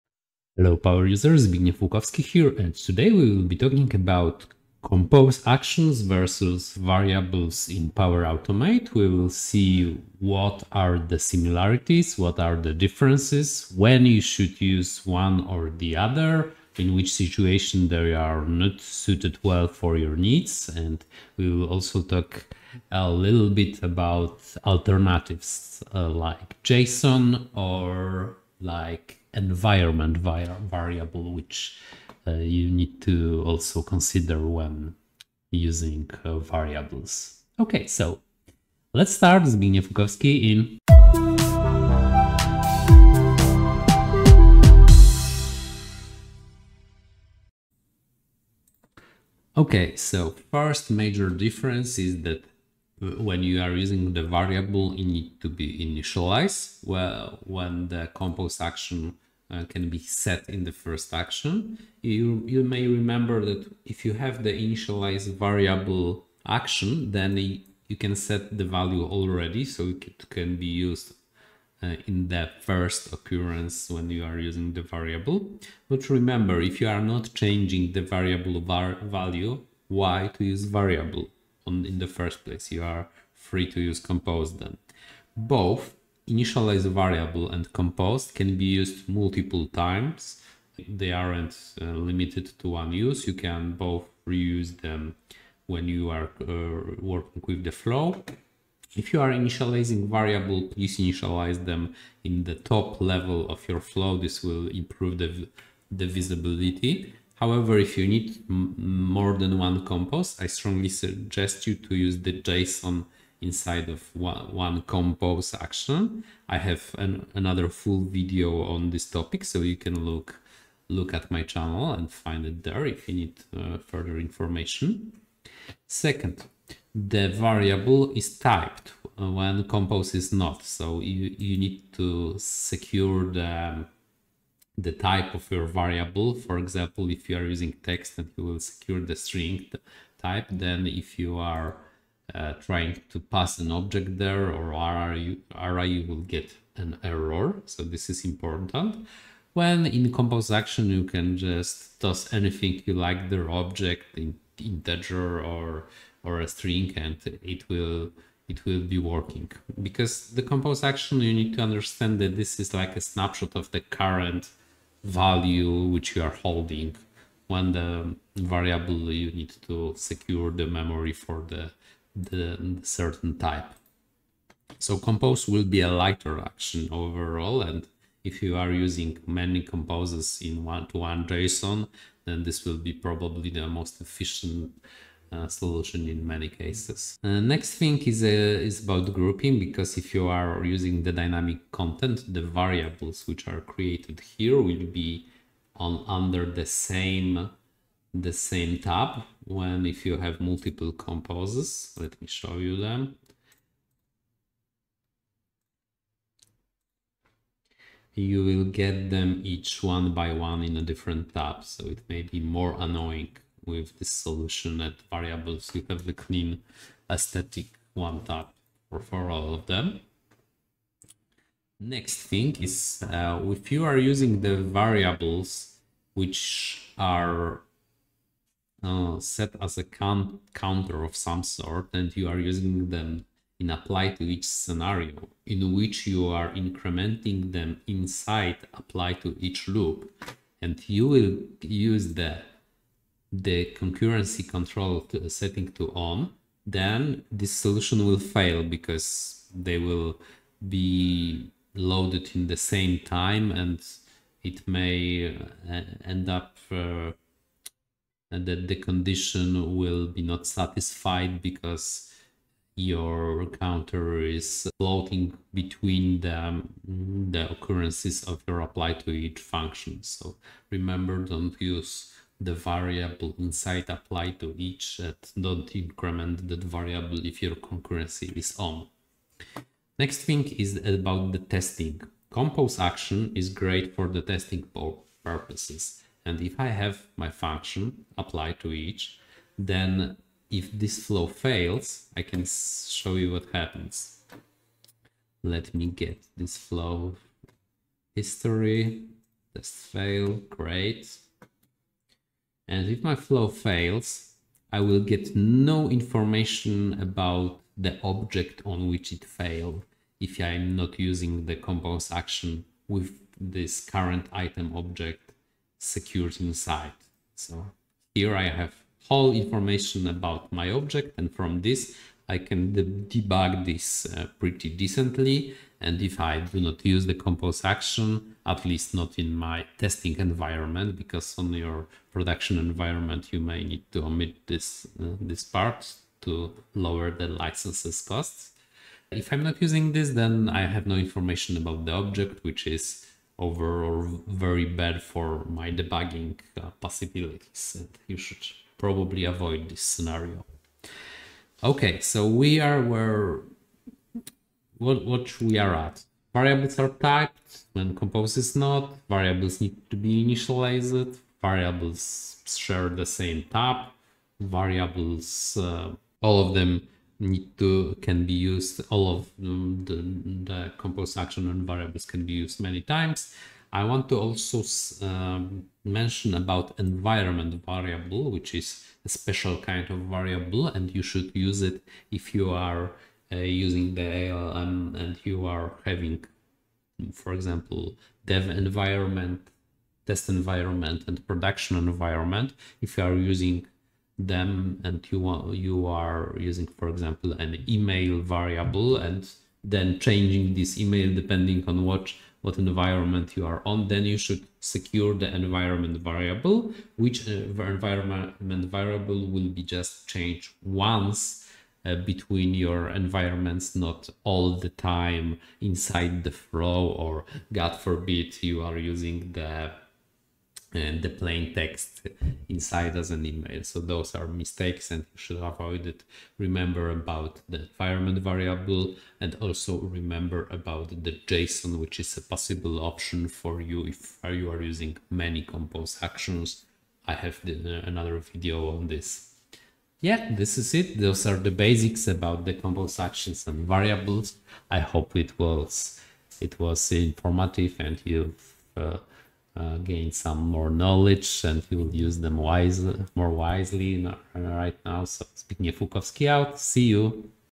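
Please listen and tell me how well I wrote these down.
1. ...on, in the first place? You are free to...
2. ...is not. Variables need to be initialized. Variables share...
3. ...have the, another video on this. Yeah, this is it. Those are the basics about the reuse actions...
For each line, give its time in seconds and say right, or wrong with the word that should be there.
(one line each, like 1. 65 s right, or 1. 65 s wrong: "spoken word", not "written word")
1. 81 s right
2. 358 s right
3. 437 s wrong: "compose", not "reuse".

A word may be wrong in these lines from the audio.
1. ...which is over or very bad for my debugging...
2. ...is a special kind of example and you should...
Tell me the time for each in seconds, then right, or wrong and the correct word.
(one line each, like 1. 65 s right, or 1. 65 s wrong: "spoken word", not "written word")
1. 342 s right
2. 378 s wrong: "variable", not "example".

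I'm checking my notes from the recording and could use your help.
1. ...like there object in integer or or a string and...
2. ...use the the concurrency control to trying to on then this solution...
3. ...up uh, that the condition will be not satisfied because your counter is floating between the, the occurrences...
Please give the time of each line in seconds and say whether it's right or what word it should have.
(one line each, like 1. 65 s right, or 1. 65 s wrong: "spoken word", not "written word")
1. 152 s right
2. 241 s wrong: "setting", not "trying"
3. 256 s right.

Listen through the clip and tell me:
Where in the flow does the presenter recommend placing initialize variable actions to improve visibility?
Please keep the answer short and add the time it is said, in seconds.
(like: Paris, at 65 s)
Top level, at 102 s.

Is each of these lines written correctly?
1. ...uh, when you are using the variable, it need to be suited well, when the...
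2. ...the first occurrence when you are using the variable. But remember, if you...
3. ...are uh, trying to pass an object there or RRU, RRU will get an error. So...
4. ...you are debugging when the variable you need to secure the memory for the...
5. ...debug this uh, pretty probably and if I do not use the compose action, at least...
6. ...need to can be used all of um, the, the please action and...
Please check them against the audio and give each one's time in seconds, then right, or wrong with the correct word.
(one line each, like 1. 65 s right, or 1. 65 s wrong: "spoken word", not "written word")
1. 53 s wrong: "initialized", not "suited"
2. 72 s right
3. 141 s right
4. 166 s wrong: "holding", not "debugging"
5. 322 s wrong: "decently", not "probably"
6. 367 s wrong: "compose", not "please".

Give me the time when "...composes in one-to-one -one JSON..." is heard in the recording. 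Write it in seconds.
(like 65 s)
179 s.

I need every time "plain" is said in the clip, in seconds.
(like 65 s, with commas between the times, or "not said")
421 s.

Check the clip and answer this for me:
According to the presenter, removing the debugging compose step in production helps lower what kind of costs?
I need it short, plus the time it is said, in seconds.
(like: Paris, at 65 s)
Licenses costs, at 337 s.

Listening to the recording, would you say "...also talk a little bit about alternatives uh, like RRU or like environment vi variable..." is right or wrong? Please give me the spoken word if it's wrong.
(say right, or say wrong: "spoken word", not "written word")
wrong: "JSON", not "RRU".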